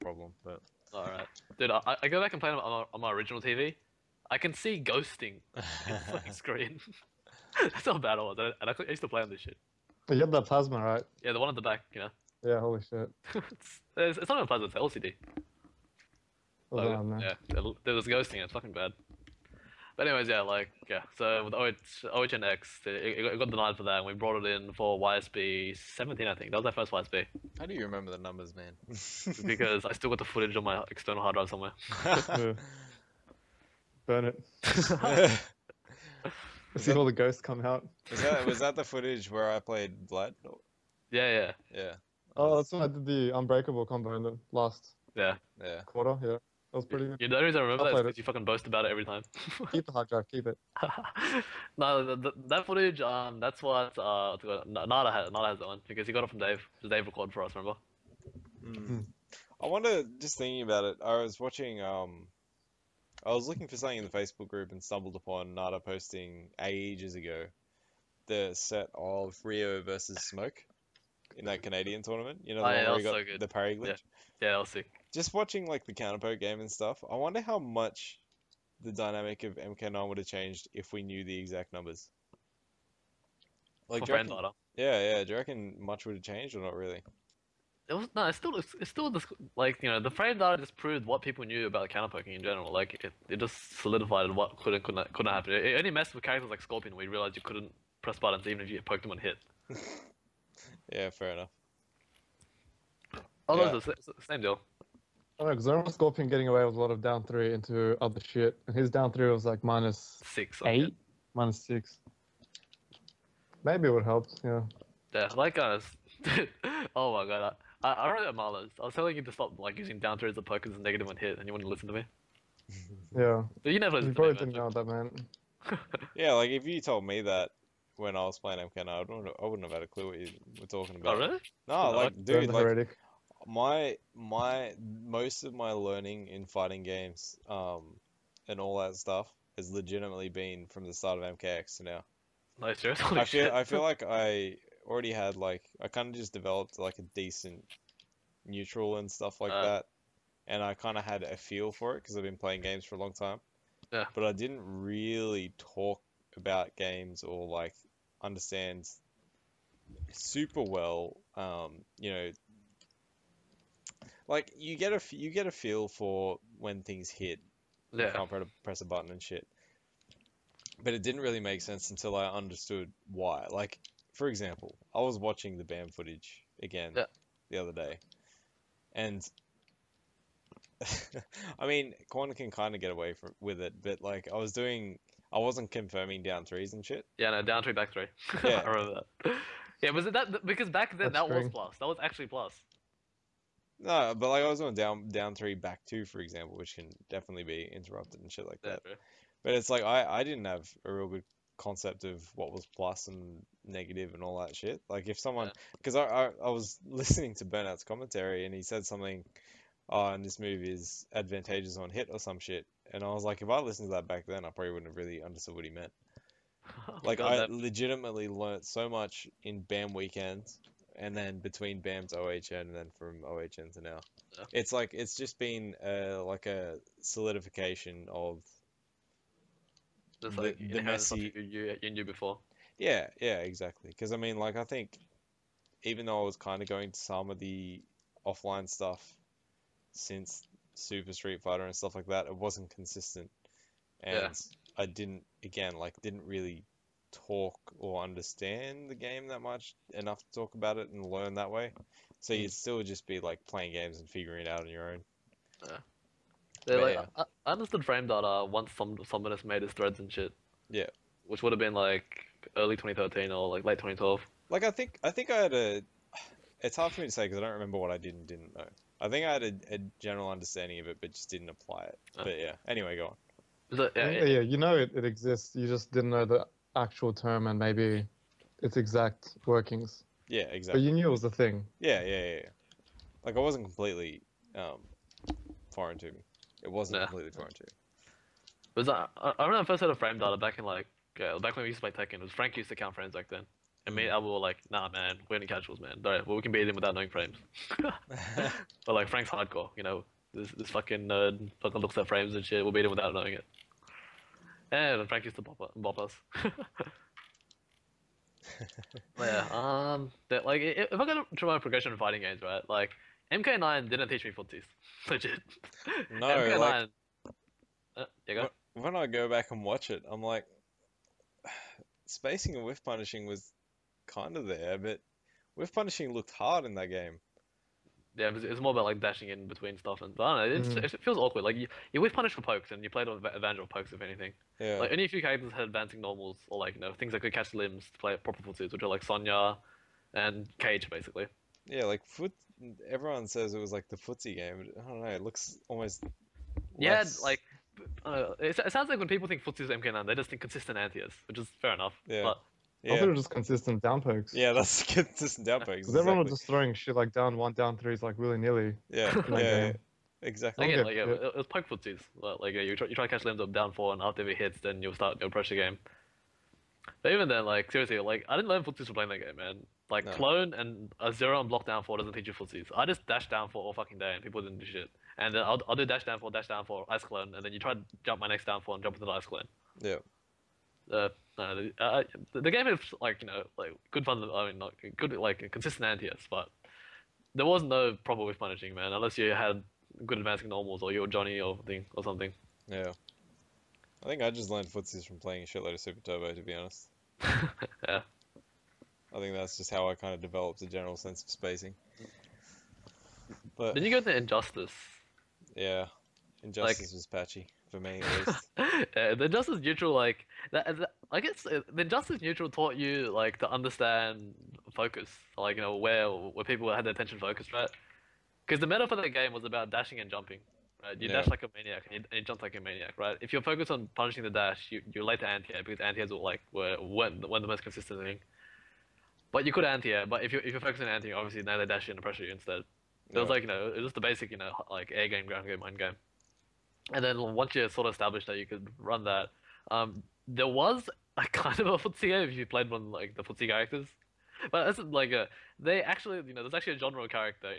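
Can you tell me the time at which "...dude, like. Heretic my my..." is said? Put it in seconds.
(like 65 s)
132 s.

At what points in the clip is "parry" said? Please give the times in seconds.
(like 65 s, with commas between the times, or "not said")
73 s.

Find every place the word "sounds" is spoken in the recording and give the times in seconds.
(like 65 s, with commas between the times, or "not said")
348 s.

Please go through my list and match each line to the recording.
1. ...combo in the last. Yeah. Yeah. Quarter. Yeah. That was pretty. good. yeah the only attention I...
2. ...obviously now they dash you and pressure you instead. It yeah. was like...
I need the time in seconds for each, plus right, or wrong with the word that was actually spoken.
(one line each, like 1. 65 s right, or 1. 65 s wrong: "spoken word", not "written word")
1. 43 s wrong: "reason", not "attention"
2. 431 s right.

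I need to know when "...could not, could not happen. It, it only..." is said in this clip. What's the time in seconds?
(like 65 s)
94 s.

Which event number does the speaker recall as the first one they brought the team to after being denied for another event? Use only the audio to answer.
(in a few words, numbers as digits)
YSB 17.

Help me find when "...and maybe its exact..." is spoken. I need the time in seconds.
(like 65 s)
277 s.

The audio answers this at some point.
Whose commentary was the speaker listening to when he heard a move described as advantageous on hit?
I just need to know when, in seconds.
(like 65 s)
207 s.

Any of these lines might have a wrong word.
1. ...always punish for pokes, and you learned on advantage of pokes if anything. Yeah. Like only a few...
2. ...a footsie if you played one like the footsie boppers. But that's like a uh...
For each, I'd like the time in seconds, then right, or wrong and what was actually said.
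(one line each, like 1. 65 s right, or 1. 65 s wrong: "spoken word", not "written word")
1. 331 s wrong: "played", not "learned"
2. 441 s wrong: "characters", not "boppers".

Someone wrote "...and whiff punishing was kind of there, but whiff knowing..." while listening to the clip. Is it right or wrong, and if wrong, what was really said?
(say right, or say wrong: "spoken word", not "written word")
wrong: "punishing", not "knowing".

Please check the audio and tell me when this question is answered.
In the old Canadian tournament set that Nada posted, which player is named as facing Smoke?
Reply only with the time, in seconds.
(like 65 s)
69 s.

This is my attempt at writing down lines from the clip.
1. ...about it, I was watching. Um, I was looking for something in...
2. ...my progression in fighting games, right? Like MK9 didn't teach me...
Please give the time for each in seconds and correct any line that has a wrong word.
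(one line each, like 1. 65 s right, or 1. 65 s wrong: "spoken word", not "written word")
1. 60 s right
2. 311 s right.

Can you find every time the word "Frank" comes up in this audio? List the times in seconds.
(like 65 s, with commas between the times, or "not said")
292 s, 299 s.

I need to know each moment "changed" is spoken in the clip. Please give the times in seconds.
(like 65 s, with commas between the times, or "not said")
80 s, 86 s.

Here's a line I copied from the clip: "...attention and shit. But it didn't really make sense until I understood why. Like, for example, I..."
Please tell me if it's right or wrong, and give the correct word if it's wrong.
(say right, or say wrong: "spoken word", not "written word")
wrong: "button", not "attention".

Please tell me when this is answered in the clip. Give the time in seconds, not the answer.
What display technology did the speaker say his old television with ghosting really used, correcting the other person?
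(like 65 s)
14 s.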